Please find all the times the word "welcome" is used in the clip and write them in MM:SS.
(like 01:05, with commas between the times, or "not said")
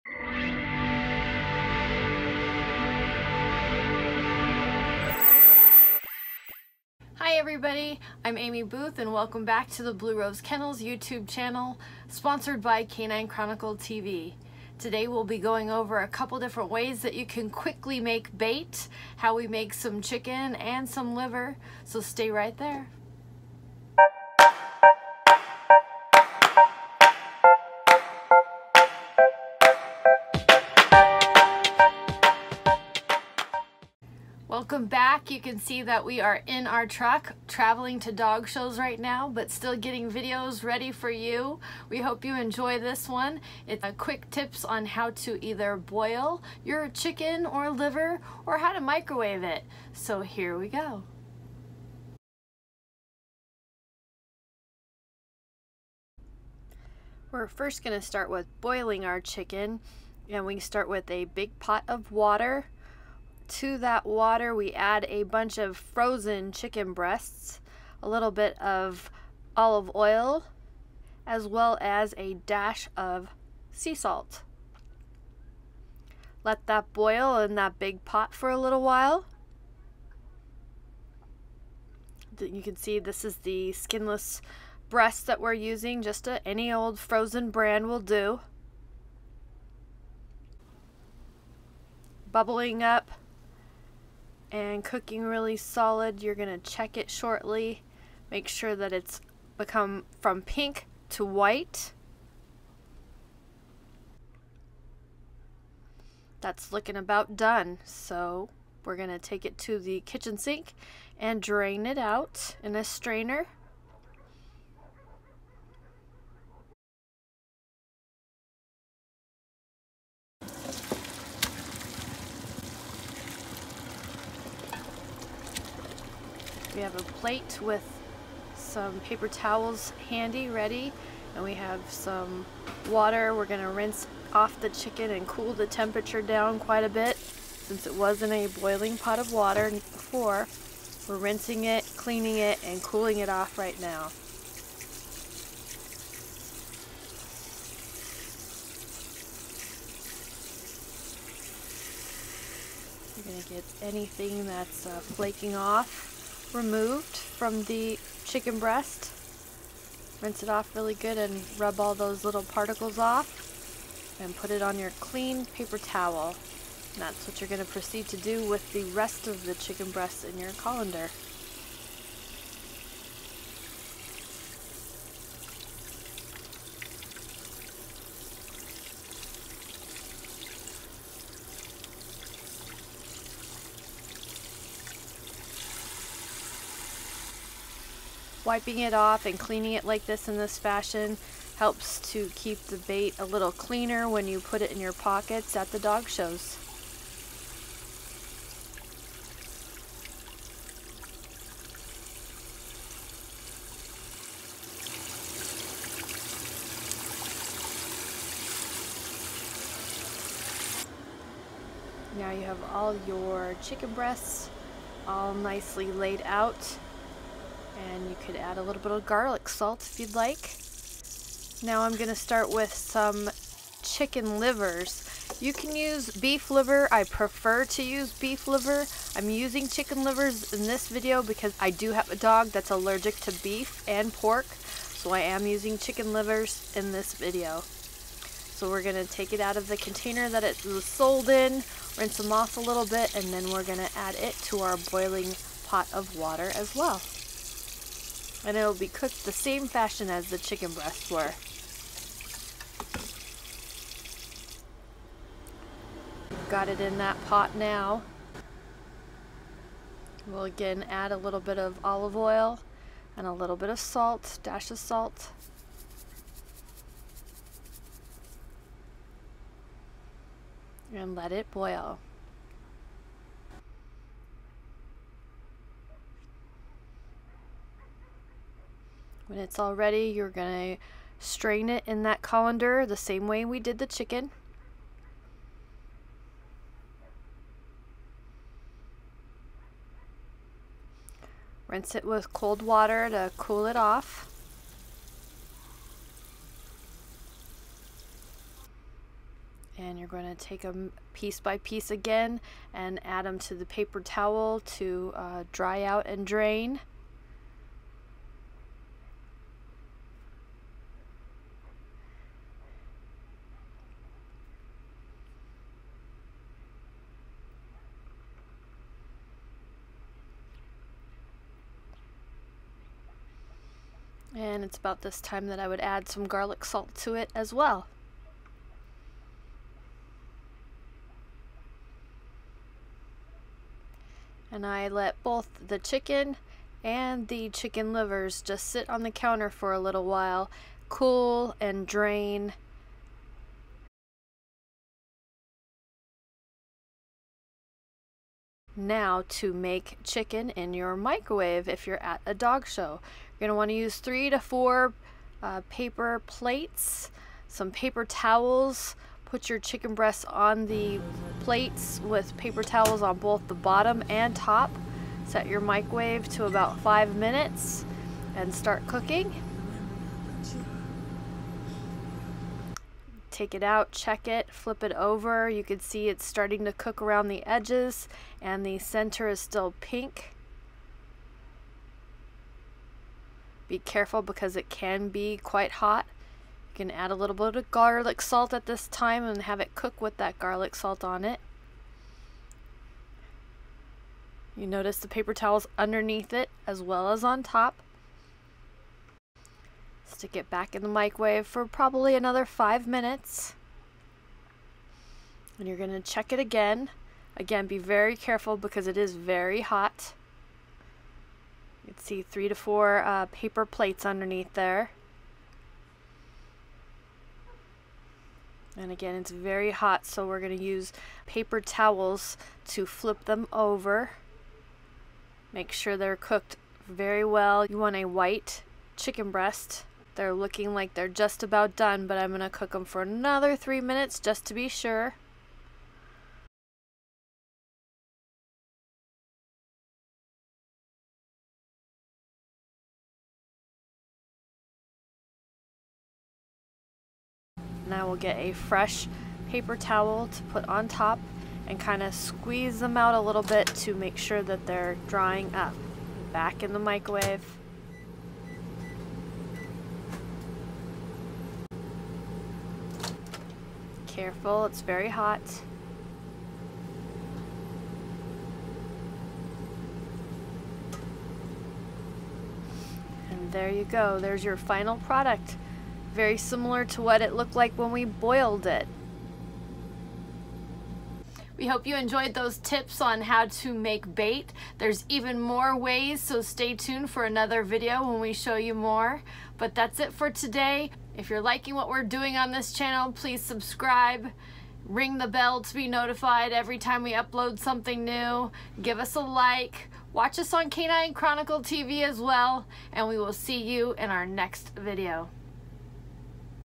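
00:09, 00:34.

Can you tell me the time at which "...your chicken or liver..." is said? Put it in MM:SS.
00:46.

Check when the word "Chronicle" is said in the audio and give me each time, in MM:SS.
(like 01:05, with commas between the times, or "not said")
00:13, 08:21.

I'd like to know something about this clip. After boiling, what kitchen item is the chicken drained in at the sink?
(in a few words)
strainer.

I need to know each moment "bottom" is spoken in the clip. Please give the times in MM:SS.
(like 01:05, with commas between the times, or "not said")
06:03.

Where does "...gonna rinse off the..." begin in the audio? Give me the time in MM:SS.
02:13.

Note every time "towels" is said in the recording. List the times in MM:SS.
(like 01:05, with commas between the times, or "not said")
02:09, 02:45, 05:04, 05:58, 06:02, 06:35, 07:01, 07:29.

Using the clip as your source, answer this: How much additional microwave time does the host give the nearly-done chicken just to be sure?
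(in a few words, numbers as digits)
3 minutes.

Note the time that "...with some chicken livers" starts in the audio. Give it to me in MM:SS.
03:42.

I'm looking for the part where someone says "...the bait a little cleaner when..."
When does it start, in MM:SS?
03:12.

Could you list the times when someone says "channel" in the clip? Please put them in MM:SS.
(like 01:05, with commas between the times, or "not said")
00:11, 08:12.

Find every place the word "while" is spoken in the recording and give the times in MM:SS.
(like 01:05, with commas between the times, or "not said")
01:18, 05:40.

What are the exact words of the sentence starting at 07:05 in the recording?
Make sure they're cooked very well.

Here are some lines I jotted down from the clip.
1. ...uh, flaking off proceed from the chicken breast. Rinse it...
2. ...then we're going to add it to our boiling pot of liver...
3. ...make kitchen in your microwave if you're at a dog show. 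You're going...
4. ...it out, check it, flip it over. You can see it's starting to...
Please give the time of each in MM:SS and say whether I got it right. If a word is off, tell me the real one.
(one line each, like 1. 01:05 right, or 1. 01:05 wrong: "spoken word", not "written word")
1. 02:34 wrong: "removed", not "proceed"
2. 04:03 wrong: "water", not "liver"
3. 05:49 wrong: "chicken", not "kitchen"
4. 06:13 right.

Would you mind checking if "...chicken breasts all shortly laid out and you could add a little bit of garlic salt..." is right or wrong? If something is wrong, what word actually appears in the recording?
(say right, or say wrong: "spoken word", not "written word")
wrong: "nicely", not "shortly".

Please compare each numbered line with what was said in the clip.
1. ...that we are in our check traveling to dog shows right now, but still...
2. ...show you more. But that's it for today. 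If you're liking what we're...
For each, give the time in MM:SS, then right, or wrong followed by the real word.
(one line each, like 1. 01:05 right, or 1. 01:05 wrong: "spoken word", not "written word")
1. 00:35 wrong: "truck", not "check"
2. 08:08 right.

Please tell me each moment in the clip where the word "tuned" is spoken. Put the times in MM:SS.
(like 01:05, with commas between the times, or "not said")
08:06.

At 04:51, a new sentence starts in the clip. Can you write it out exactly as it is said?
Rinse it with cold water to cool it off.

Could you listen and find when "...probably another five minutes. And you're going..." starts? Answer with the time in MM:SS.
06:41.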